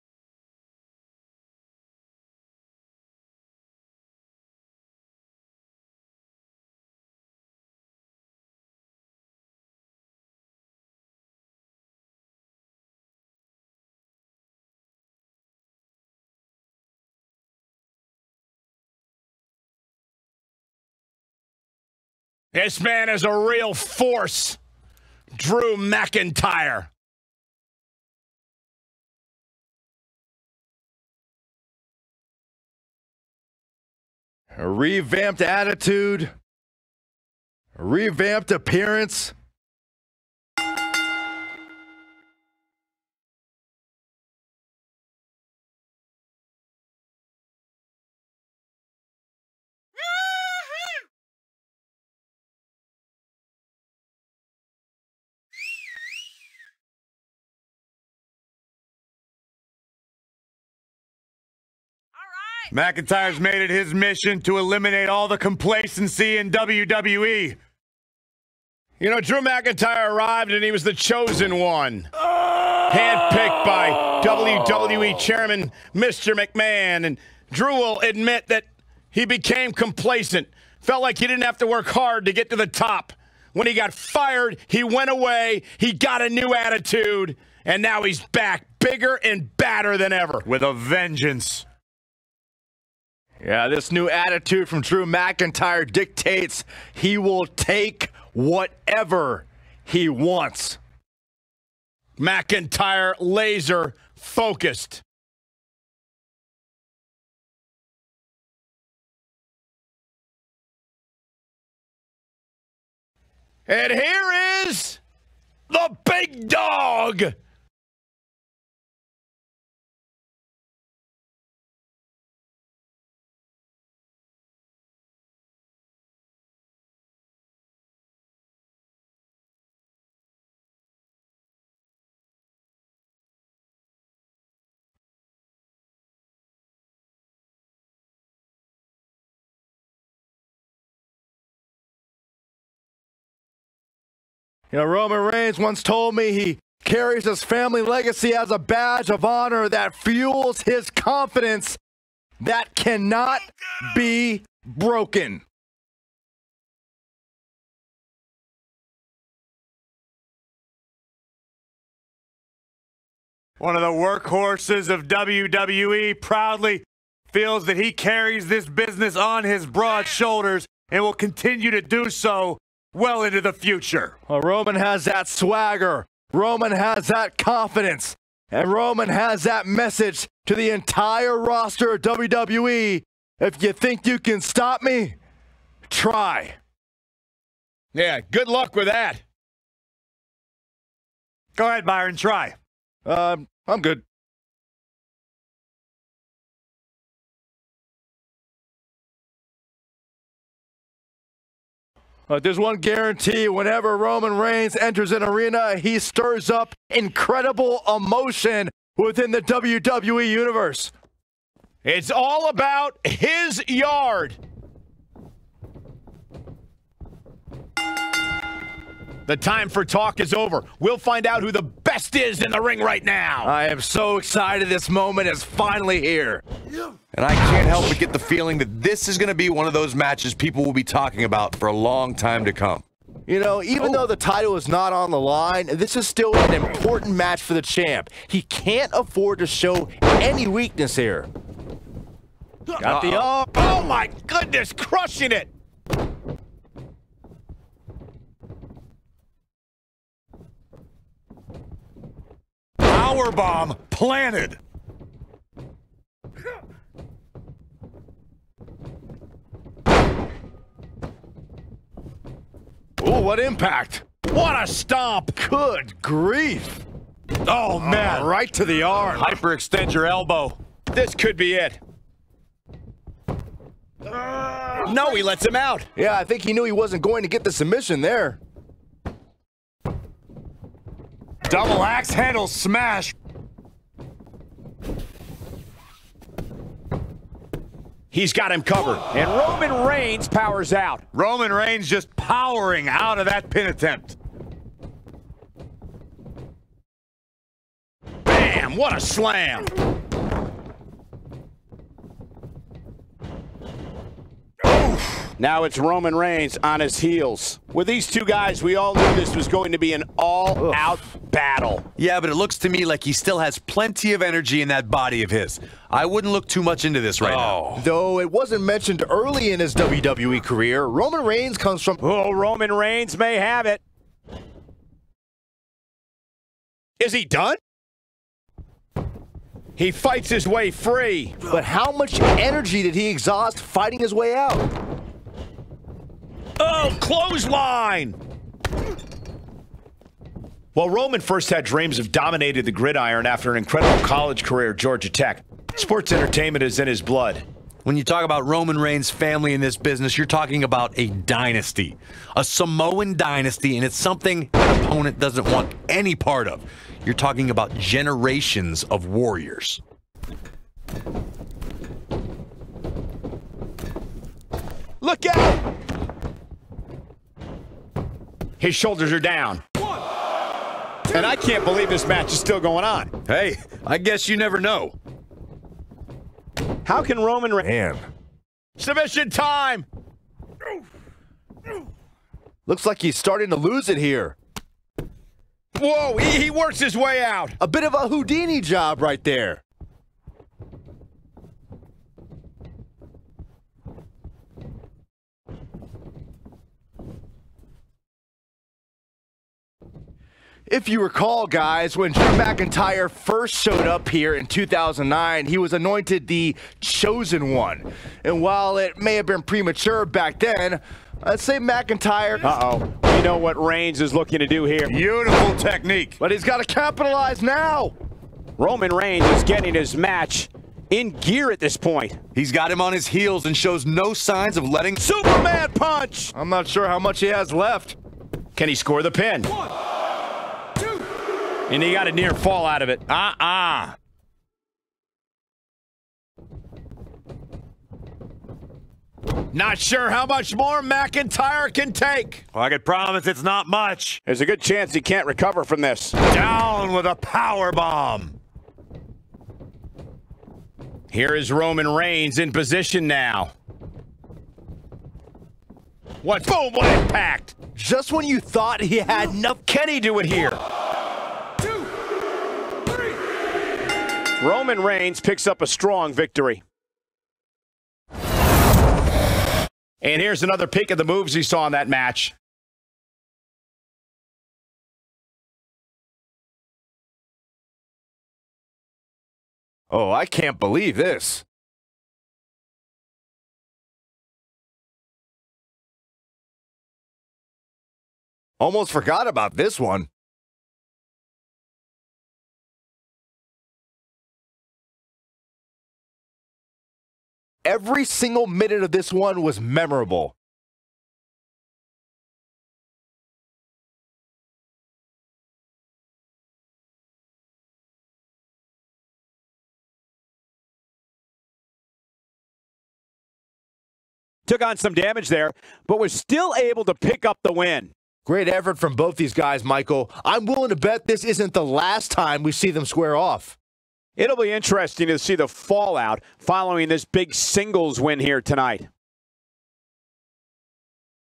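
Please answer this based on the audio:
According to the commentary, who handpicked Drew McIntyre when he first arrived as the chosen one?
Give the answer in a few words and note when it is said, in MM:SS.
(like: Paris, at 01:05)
Mr. McMahon, at 01:15.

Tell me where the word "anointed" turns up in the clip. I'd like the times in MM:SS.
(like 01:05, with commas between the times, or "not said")
06:45.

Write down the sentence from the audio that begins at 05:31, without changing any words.
But how much energy did he exhaust fighting his way out?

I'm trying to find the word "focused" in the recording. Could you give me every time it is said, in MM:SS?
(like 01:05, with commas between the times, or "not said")
01:44.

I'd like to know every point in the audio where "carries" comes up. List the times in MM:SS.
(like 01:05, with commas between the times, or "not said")
02:26, 02:47.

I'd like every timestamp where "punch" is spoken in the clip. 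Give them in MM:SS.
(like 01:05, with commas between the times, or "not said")
07:05.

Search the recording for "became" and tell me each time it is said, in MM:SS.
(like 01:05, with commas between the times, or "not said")
01:19.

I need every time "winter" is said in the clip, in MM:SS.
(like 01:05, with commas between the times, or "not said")
not said.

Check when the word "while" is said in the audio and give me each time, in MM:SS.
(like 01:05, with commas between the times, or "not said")
05:40, 06:48.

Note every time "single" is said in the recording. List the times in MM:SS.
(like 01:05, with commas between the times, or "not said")
08:18, 08:47.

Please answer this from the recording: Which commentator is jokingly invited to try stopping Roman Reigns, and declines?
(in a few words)
Byron.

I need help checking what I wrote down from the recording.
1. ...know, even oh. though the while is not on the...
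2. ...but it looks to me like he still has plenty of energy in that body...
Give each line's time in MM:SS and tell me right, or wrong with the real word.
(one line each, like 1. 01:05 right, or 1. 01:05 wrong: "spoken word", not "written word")
1. 03:53 wrong: "title", not "while"
2. 05:12 right.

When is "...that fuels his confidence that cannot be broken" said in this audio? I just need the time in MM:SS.
02:29.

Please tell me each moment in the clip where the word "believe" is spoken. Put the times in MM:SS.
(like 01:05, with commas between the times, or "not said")
06:11, 08:00.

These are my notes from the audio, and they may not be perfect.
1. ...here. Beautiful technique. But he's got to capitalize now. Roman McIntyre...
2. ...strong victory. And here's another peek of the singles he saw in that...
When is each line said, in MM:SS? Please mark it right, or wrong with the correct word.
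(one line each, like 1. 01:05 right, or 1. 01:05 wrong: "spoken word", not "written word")
1. 06:54 wrong: "Reigns", not "McIntyre"
2. 07:45 wrong: "moves", not "singles".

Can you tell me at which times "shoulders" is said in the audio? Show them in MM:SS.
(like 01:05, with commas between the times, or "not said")
02:50, 06:08.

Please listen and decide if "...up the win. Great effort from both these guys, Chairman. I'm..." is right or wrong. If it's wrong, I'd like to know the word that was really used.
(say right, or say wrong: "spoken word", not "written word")
wrong: "Michael", not "Chairman".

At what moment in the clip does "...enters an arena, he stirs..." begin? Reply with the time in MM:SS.
03:24.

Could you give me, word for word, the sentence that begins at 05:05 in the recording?
Now it's Roman Reigns on his heels.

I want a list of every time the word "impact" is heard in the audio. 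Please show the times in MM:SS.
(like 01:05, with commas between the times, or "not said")
04:23, 07:37.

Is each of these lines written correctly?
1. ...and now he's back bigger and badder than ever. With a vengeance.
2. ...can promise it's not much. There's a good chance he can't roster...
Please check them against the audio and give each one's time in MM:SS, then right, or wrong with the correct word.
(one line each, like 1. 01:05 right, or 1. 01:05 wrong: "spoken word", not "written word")
1. 01:27 right
2. 07:22 wrong: "recover", not "roster".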